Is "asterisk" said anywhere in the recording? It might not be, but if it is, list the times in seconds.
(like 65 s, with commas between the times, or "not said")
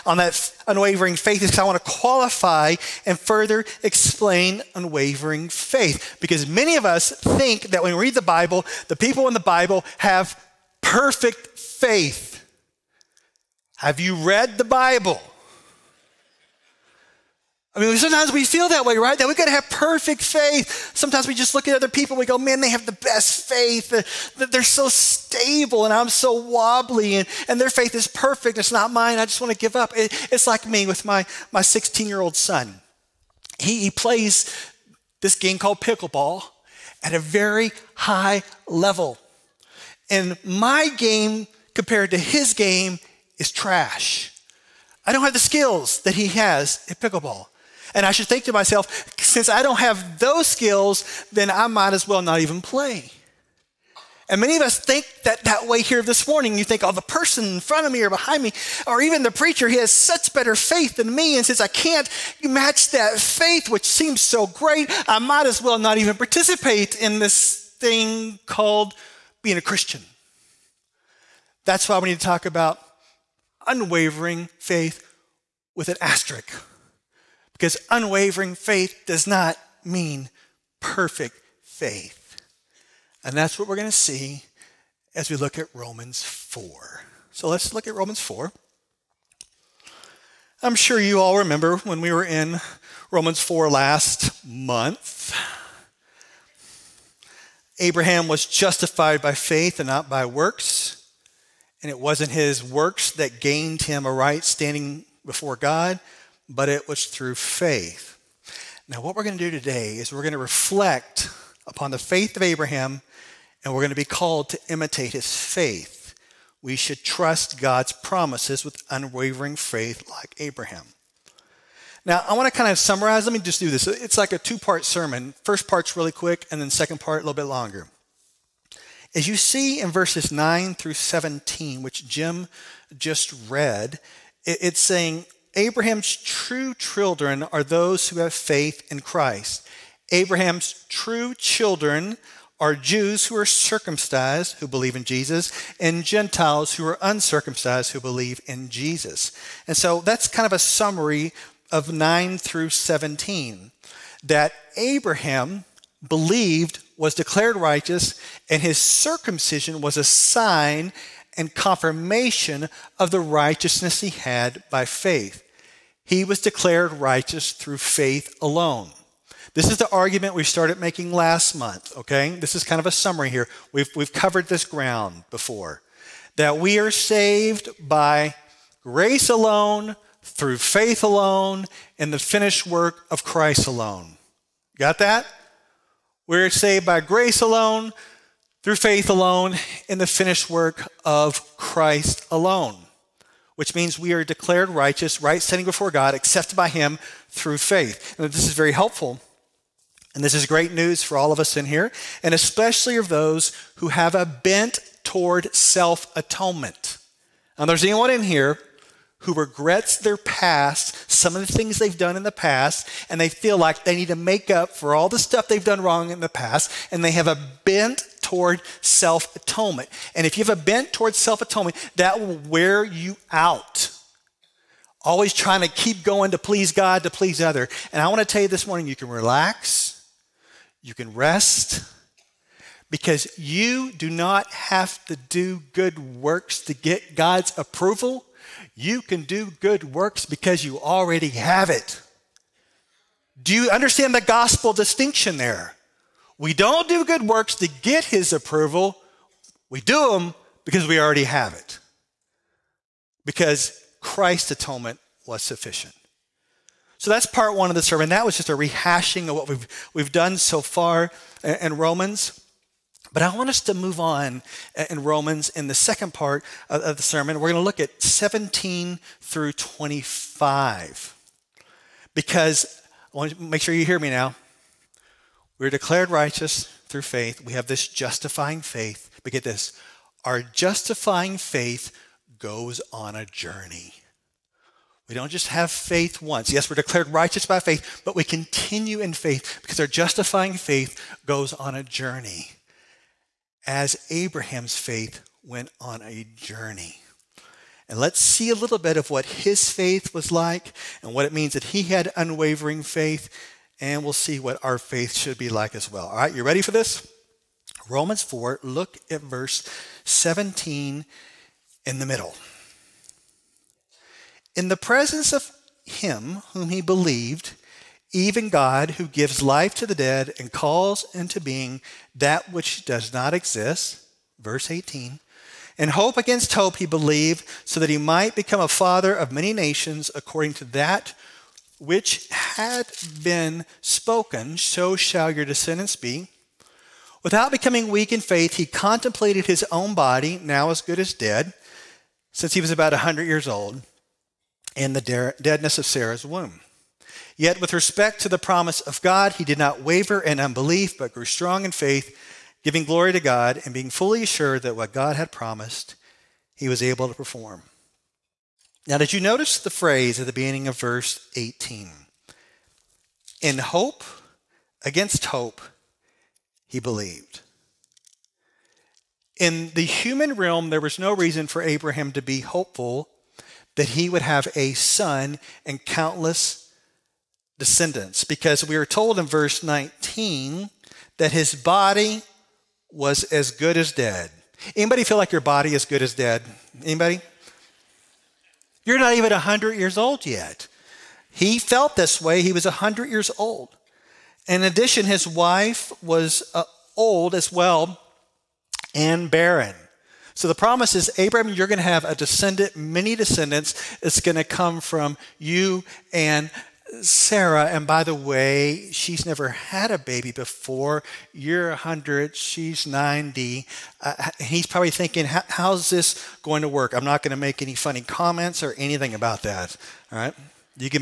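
76 s.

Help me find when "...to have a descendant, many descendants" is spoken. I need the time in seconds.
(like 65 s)
401 s.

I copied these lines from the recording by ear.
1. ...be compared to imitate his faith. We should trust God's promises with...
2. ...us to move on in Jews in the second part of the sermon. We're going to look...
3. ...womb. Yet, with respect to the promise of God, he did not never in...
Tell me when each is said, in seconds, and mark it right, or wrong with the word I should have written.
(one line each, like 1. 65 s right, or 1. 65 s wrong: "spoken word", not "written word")
1. 113 s wrong: "called", not "compared"
2. 263 s wrong: "Romans", not "Jews"
3. 346 s wrong: "waver", not "never".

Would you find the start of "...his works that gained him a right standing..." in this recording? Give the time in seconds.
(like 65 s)
102 s.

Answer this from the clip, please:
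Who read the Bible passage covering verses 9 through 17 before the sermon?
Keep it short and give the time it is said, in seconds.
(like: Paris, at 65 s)
Jim, at 132 s.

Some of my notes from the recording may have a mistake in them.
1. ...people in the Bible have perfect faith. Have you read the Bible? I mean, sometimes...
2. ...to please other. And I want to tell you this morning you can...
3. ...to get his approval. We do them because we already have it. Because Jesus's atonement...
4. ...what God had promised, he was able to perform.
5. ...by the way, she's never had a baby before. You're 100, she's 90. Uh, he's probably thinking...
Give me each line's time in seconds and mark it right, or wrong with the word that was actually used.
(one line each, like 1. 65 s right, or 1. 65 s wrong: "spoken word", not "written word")
1. 8 s right
2. 227 s right
3. 247 s wrong: "Christ", not "Jesus"
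4. 354 s right
5. 407 s right.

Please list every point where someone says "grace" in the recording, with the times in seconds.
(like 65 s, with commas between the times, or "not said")
178 s, 187 s.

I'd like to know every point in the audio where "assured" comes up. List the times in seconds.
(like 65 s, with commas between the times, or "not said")
354 s.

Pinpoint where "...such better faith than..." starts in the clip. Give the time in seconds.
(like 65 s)
59 s.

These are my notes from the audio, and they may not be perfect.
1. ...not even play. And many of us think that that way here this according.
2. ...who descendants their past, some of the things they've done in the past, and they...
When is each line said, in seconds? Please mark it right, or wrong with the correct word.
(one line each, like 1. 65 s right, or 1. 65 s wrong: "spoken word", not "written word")
1. 52 s wrong: "morning", not "according"
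2. 209 s wrong: "regrets", not "descendants".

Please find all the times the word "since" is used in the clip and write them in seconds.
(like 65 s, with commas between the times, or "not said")
49 s, 61 s, 342 s.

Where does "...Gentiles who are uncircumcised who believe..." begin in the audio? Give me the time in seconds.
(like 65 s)
146 s.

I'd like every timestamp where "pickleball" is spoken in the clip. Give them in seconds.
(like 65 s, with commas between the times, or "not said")
35 s, 46 s.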